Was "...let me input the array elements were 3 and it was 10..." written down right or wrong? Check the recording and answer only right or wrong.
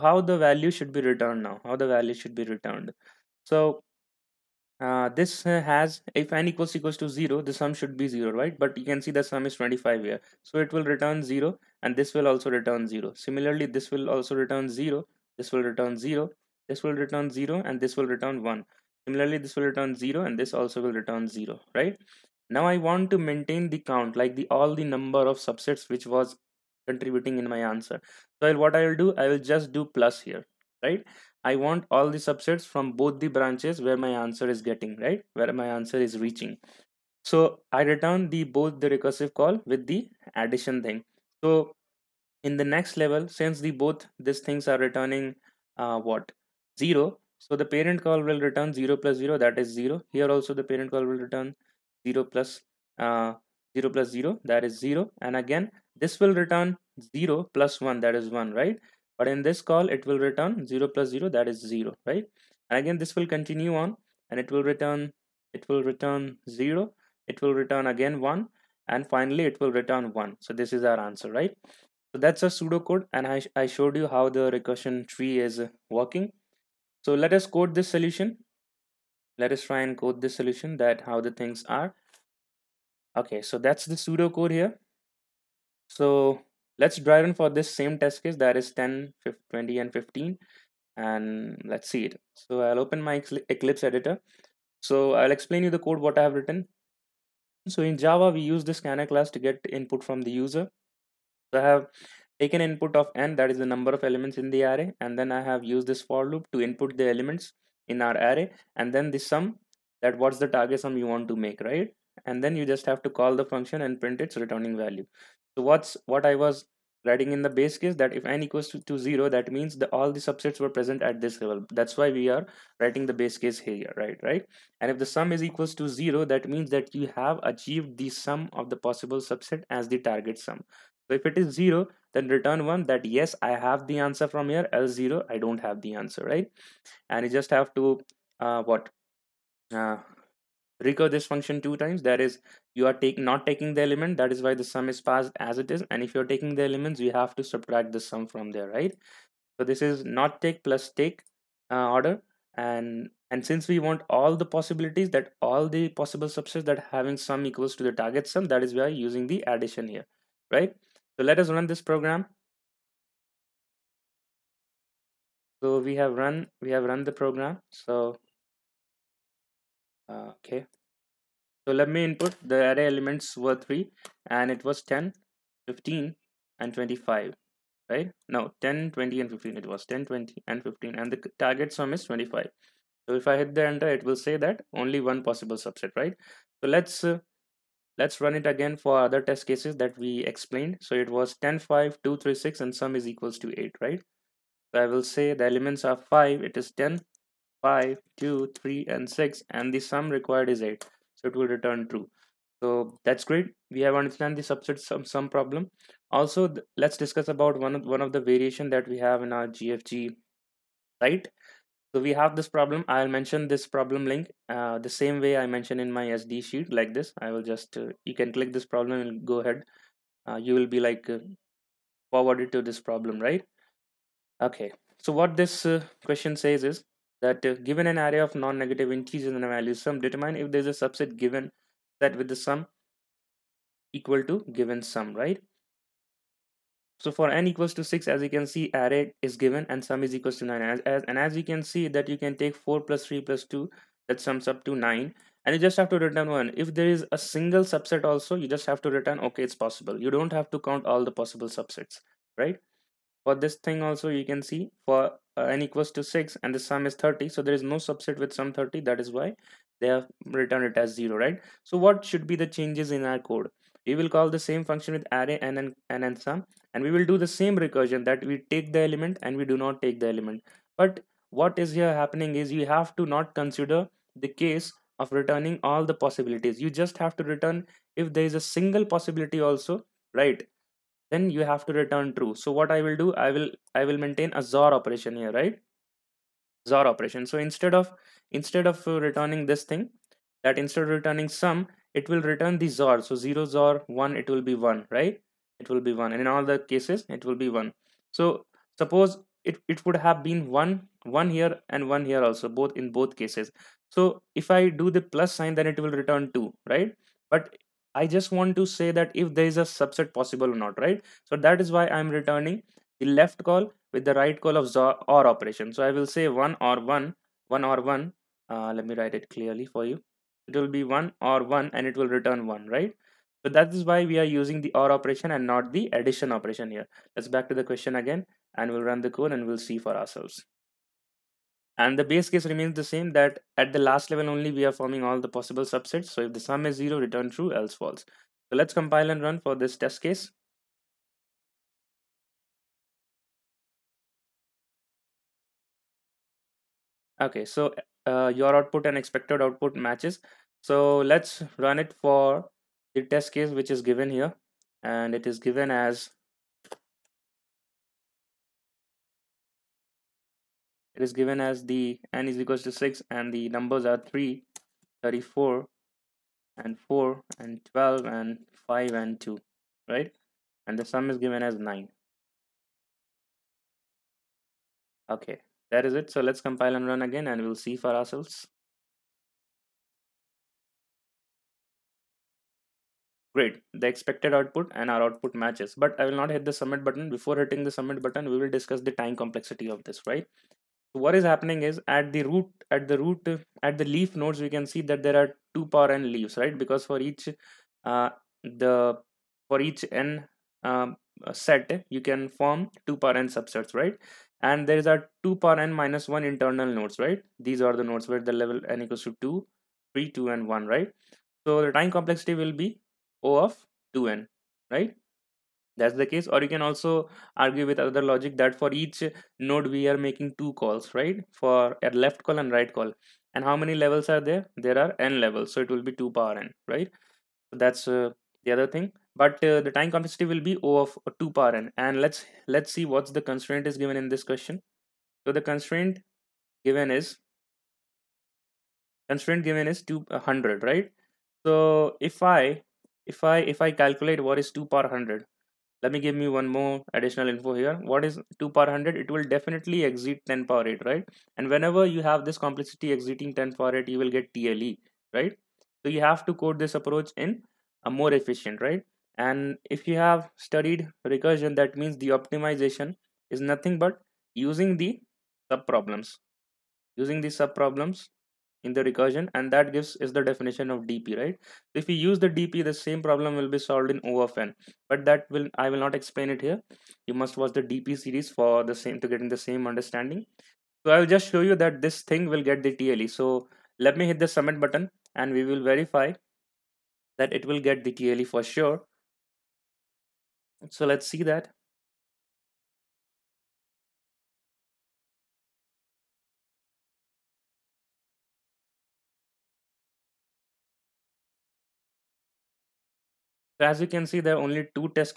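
right.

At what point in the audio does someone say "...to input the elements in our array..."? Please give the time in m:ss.
1:46.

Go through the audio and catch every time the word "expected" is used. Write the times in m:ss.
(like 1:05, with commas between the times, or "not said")
5:48, 6:23.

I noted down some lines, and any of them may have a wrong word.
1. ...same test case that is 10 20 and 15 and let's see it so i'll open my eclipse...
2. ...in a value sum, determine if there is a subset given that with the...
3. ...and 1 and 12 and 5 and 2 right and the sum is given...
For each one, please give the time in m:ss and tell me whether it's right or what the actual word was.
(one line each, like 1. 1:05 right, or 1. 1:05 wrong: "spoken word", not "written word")
1. 1:27 right
2. 3:49 right
3. 6:06 wrong: "4", not "1".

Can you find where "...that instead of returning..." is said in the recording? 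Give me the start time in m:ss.
4:50.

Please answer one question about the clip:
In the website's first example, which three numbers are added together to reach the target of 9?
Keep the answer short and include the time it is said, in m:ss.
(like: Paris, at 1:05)
4, 3 and 2, at 4:02.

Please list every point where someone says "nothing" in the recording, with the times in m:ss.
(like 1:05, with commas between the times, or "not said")
7:43.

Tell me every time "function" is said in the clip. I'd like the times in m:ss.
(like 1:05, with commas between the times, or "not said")
1:53, 2:21, 4:24.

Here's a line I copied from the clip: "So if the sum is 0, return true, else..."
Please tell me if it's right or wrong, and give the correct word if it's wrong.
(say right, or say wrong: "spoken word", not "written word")
right.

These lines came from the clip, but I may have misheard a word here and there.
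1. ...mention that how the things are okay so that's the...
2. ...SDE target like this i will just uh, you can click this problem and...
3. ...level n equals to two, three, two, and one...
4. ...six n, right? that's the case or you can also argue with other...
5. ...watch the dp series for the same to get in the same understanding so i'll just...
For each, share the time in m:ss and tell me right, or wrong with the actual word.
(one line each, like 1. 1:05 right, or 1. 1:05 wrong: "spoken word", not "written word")
1. 1:20 wrong: "solution", not "mention"
2. 3:36 wrong: "sheet", not "target"
3. 6:48 right
4. 6:53 wrong: "two", not "six"
5. 7:57 right.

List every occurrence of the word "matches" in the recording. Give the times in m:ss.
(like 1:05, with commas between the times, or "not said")
5:49, 6:25.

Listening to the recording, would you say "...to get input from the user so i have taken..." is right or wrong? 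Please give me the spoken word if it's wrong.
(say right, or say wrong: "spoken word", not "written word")
right.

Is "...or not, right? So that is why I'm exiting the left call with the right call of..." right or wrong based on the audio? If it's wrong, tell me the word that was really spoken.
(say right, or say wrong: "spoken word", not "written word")
wrong: "returning", not "exiting".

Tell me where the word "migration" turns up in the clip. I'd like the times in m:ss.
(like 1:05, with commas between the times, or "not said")
not said.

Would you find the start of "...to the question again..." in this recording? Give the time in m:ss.
5:27.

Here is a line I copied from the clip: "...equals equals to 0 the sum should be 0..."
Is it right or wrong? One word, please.
right.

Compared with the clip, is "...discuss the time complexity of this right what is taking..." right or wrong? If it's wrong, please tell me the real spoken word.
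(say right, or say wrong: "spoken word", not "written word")
wrong: "happening", not "taking".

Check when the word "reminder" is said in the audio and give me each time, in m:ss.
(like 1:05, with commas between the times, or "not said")
not said.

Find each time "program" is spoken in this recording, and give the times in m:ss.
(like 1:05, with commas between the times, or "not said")
2:41, 2:47.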